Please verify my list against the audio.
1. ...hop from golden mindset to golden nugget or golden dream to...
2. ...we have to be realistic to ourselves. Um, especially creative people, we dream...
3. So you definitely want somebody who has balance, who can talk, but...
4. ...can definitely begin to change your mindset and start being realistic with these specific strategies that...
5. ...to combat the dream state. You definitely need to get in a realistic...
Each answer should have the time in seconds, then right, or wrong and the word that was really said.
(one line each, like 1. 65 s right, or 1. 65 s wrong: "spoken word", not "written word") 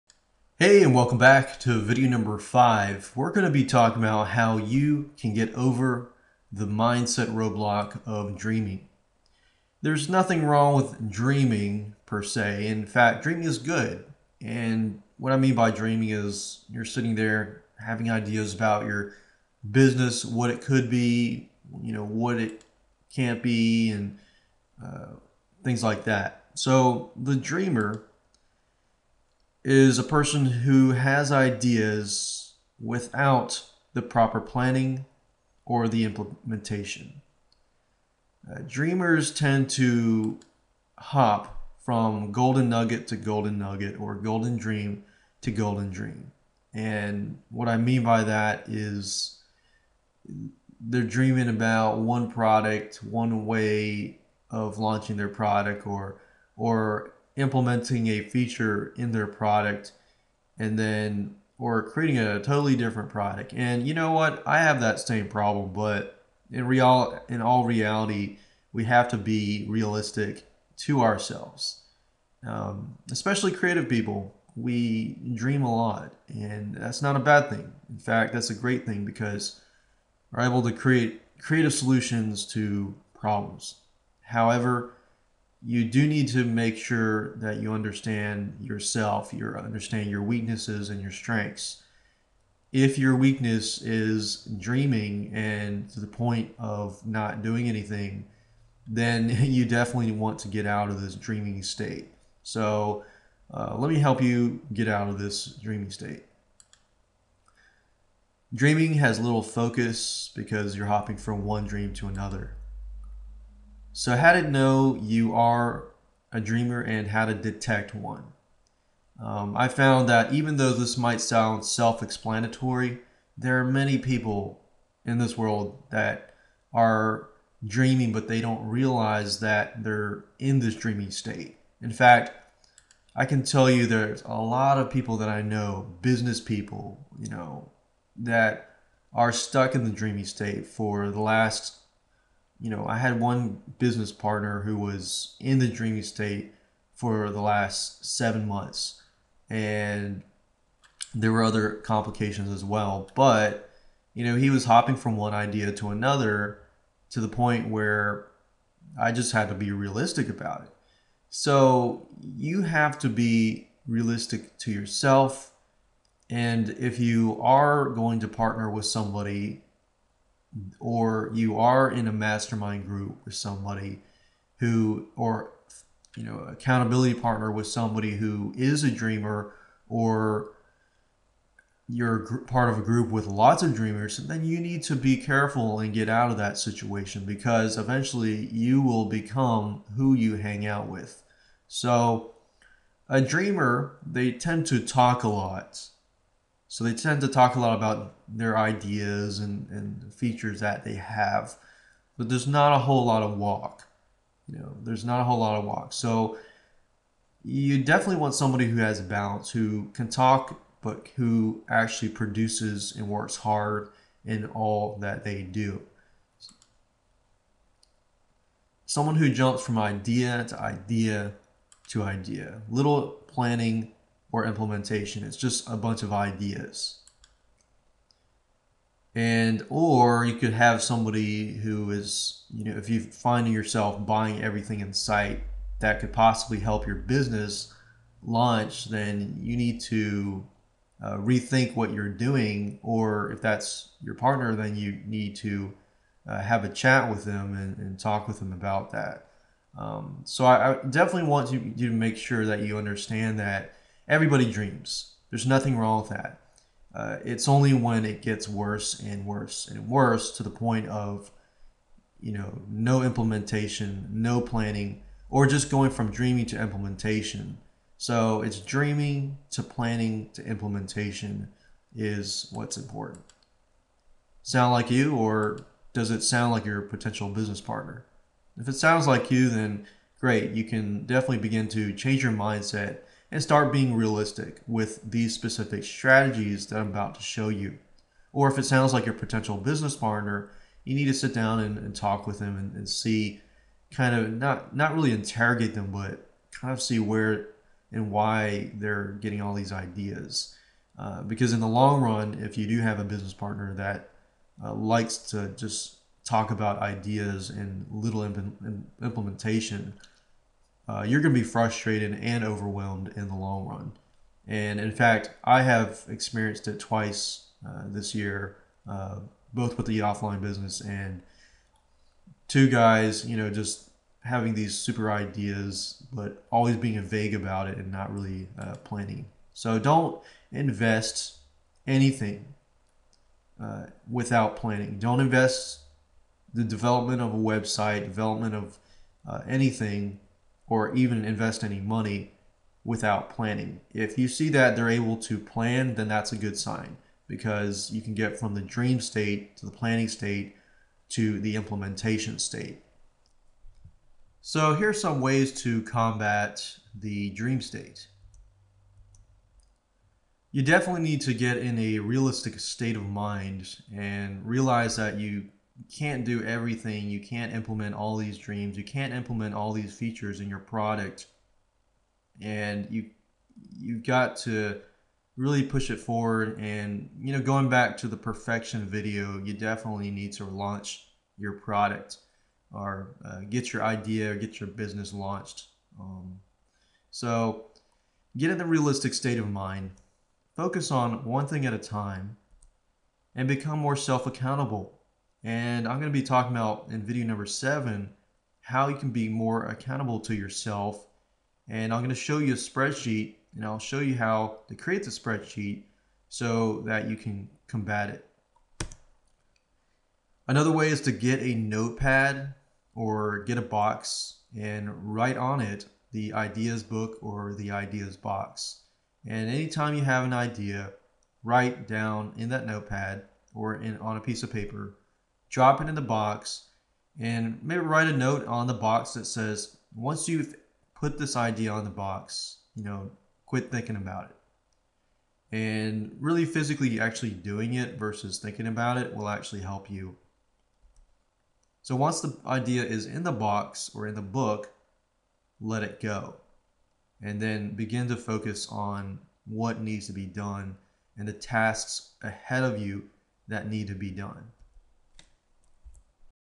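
1. 40 s wrong: "nugget", not "mindset"
2. 68 s right
3. 205 s right
4. 280 s right
5. 355 s right.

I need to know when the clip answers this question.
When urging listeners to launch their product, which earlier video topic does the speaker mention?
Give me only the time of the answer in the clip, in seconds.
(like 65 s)
378 s.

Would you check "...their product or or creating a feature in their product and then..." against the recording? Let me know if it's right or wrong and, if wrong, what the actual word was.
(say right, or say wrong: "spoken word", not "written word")
wrong: "implementing", not "creating".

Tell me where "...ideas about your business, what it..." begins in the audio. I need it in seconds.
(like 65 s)
18 s.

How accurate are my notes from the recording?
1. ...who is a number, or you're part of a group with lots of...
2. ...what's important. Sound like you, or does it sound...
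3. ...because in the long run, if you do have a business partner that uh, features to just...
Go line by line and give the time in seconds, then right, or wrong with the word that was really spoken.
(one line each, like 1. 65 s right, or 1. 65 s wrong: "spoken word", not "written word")
1. 178 s wrong: "dreamer", not "number"
2. 272 s right
3. 301 s wrong: "likes", not "features".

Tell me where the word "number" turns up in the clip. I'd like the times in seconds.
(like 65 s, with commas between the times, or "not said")
2 s, 397 s.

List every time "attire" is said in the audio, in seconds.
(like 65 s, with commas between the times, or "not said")
not said.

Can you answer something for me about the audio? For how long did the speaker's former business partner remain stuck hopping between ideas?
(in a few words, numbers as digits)
7 months.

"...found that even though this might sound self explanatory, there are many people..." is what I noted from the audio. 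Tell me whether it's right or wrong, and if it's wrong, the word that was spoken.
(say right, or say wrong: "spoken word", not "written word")
right.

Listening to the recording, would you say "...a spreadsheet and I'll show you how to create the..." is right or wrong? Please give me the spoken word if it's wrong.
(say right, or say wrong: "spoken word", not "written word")
right.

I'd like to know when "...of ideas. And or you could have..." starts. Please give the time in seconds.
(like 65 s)
226 s.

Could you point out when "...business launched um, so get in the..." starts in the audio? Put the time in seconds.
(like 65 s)
384 s.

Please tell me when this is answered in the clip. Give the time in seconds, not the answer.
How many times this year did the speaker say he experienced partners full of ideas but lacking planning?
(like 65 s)
316 s.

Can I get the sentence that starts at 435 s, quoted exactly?
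And really physically actually doing it versus thinking about it will actually help you.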